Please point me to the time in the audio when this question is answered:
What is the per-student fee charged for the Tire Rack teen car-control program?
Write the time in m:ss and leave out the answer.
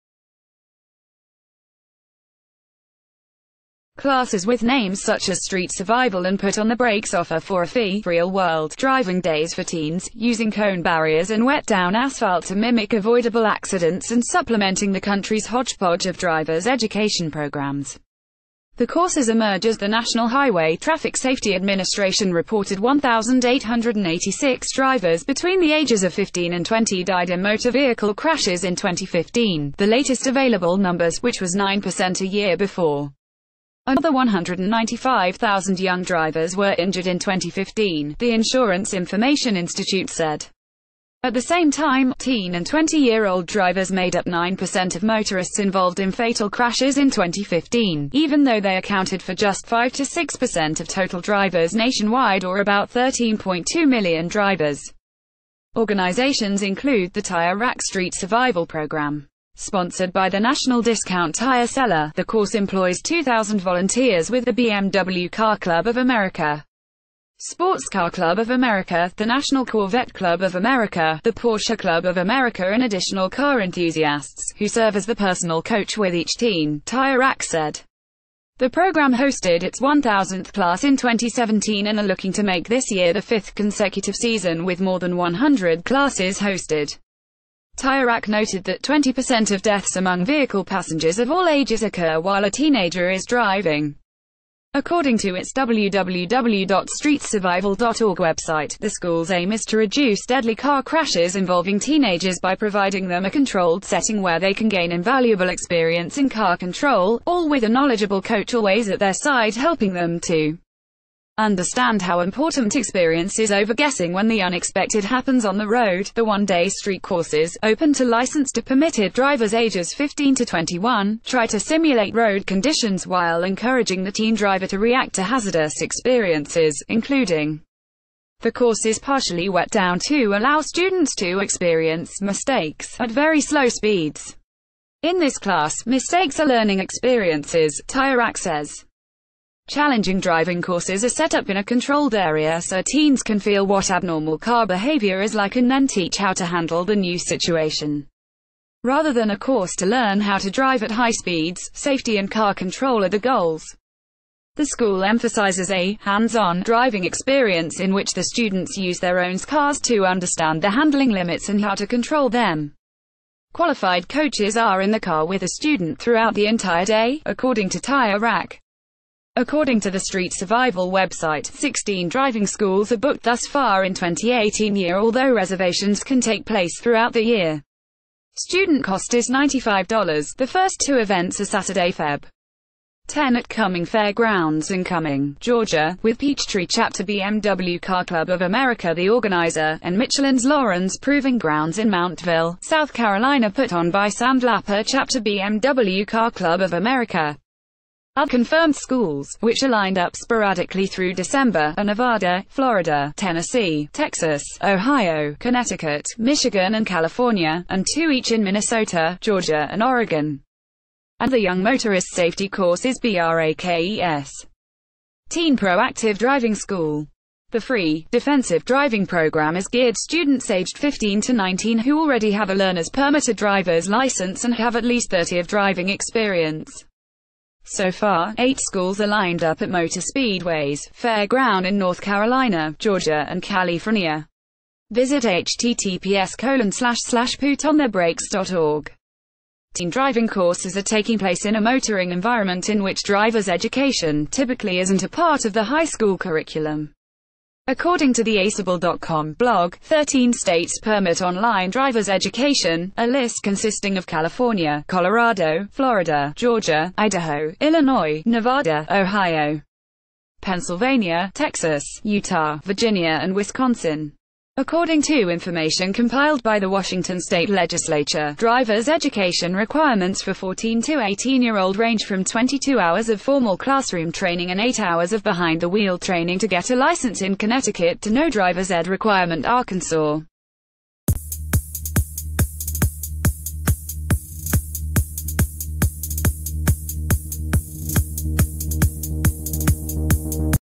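2:59.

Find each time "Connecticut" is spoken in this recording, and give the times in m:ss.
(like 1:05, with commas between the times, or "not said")
3:25, 4:37.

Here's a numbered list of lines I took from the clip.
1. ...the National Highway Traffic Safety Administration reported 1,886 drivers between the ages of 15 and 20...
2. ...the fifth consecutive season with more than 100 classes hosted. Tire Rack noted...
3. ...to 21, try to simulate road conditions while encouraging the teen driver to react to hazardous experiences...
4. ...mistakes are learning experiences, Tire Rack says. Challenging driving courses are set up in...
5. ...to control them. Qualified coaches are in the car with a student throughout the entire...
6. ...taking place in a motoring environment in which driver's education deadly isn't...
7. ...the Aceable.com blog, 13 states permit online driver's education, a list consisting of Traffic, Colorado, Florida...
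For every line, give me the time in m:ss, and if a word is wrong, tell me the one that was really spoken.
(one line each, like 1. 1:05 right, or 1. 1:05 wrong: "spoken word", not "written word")
1. 0:19 right
2. 1:23 right
3. 2:00 right
4. 2:15 right
5. 2:41 right
6. 4:00 wrong: "typically", not "deadly"
7. 4:08 wrong: "California", not "Traffic".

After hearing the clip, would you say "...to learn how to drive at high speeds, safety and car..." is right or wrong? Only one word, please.
right.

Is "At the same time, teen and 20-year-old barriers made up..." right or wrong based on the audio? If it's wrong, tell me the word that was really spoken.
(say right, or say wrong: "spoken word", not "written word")
wrong: "drivers", not "barriers".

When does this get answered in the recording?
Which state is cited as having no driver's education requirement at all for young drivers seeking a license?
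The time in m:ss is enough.
4:39.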